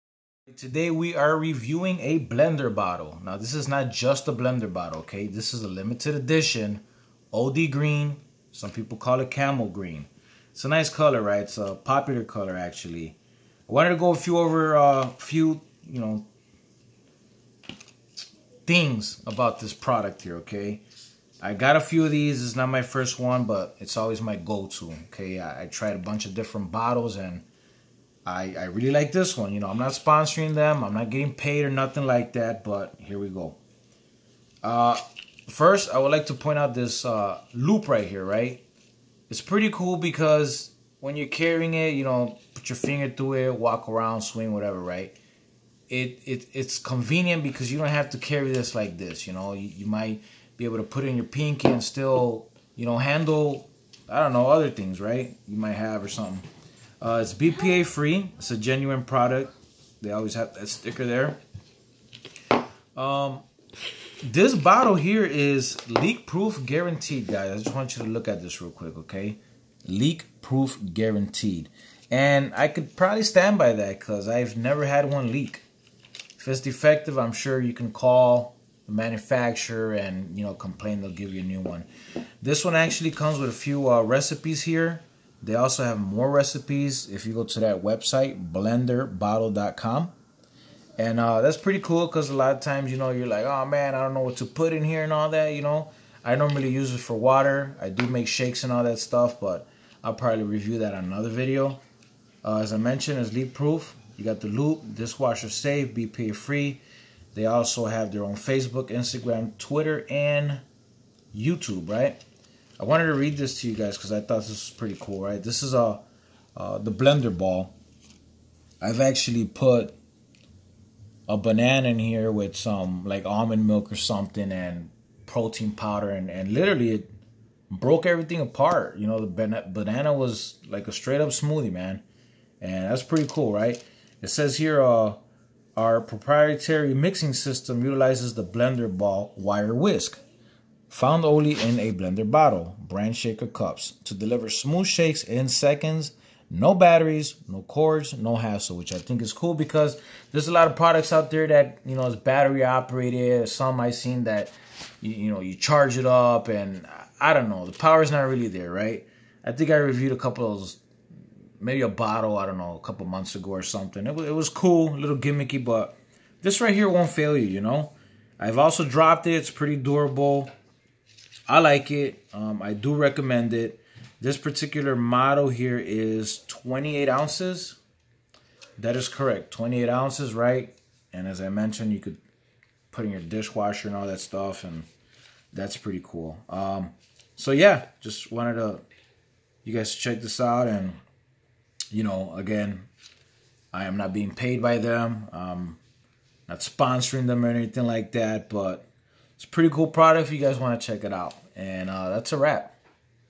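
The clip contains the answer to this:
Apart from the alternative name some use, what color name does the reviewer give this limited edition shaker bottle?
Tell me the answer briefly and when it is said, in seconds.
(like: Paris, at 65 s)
OD green, at 7 s.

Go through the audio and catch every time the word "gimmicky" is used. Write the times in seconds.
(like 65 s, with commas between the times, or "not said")
165 s.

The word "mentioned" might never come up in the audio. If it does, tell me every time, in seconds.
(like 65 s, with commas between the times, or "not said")
102 s, 181 s.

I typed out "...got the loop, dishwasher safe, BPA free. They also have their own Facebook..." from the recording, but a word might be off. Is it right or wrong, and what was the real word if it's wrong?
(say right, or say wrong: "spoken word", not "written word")
right.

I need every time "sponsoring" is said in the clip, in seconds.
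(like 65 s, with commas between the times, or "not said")
29 s, 196 s.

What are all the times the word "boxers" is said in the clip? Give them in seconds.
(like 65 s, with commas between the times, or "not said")
not said.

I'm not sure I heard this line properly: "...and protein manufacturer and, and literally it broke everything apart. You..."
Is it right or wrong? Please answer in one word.
wrong.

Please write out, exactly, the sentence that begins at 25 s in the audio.
I, I tried a bunch of different bottles and I, I really like this one.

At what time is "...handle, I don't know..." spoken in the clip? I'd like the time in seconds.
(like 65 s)
52 s.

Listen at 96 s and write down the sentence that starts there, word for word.
I normally use it for water.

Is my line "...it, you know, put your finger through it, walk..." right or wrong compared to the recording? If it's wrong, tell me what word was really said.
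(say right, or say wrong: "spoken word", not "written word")
right.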